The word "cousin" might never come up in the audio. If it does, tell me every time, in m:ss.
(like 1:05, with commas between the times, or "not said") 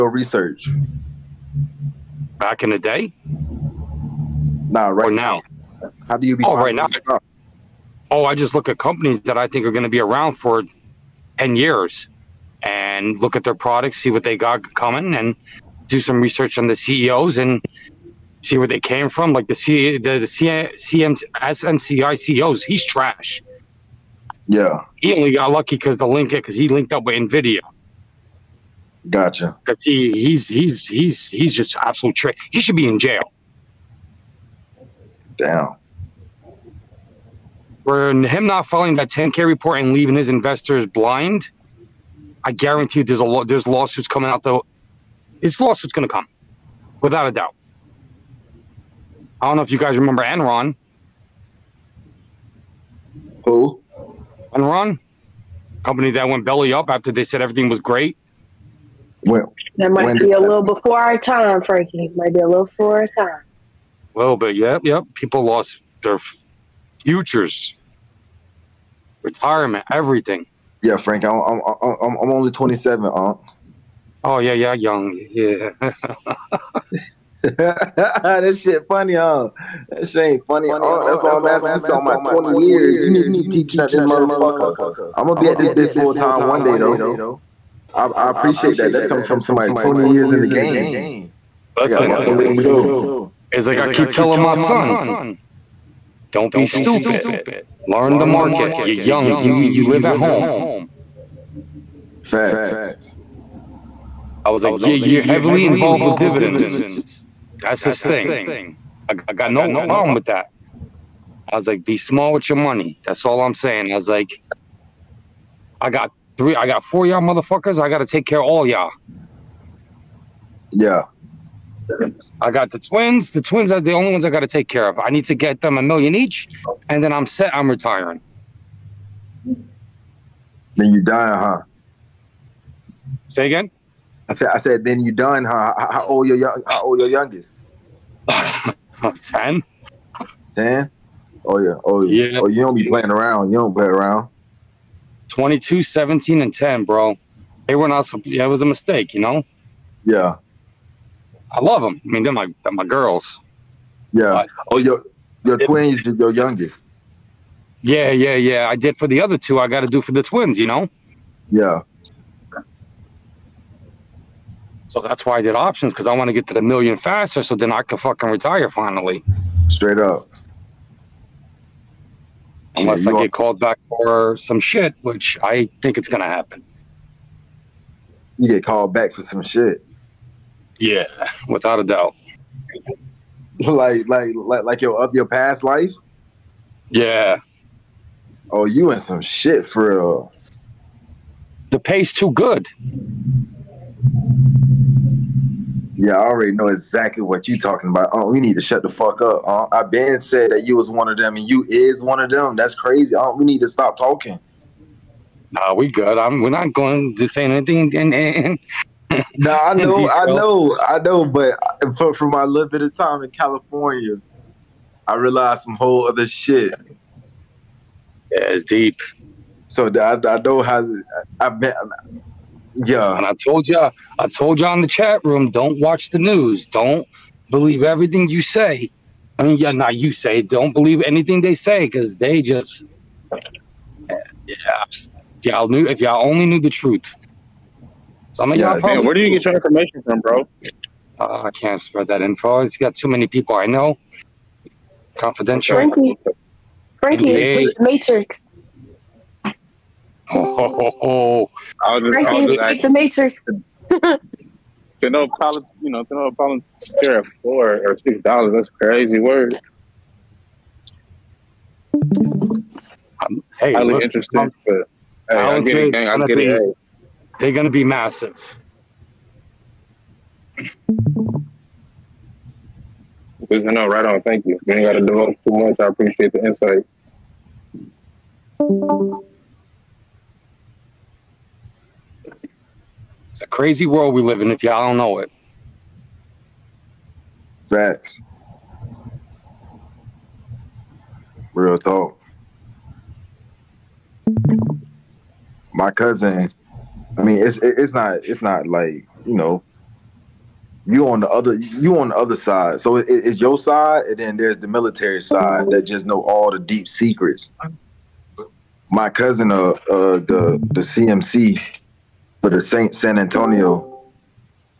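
4:55, 5:09.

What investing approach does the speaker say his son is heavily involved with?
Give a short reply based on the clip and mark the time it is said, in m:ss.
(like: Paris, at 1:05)
Dividends, at 1:46.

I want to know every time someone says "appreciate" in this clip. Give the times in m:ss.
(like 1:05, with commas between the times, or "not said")
1:28, 4:35.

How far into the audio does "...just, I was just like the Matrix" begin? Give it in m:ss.
4:12.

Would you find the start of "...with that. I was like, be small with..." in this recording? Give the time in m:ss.
1:50.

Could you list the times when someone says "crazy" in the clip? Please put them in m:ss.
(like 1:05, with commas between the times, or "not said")
3:22, 4:18, 4:43.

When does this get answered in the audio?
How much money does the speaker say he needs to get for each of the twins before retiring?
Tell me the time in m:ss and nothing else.
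2:05.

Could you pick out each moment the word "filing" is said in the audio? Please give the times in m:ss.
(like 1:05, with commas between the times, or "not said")
0:38.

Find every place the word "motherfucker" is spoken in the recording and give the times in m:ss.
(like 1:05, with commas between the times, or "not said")
1:24, 1:57.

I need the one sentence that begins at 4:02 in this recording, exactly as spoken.
It's got too many people I know.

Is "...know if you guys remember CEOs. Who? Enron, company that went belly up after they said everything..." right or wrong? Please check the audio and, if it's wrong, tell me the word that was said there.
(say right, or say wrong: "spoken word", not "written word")
wrong: "Enron", not "CEOs".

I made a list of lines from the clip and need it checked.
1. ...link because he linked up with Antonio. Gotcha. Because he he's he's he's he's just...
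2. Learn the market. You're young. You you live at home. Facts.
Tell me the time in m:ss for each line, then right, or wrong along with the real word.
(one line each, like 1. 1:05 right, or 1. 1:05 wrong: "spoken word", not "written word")
1. 0:26 wrong: "Nvidia", not "Antonio"
2. 1:37 right.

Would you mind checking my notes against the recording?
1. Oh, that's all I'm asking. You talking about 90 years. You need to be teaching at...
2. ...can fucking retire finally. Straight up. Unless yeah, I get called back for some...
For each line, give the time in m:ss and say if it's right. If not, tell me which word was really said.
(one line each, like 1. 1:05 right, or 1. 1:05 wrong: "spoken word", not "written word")
1. 1:20 wrong: "20", not "90"
2. 2:47 right.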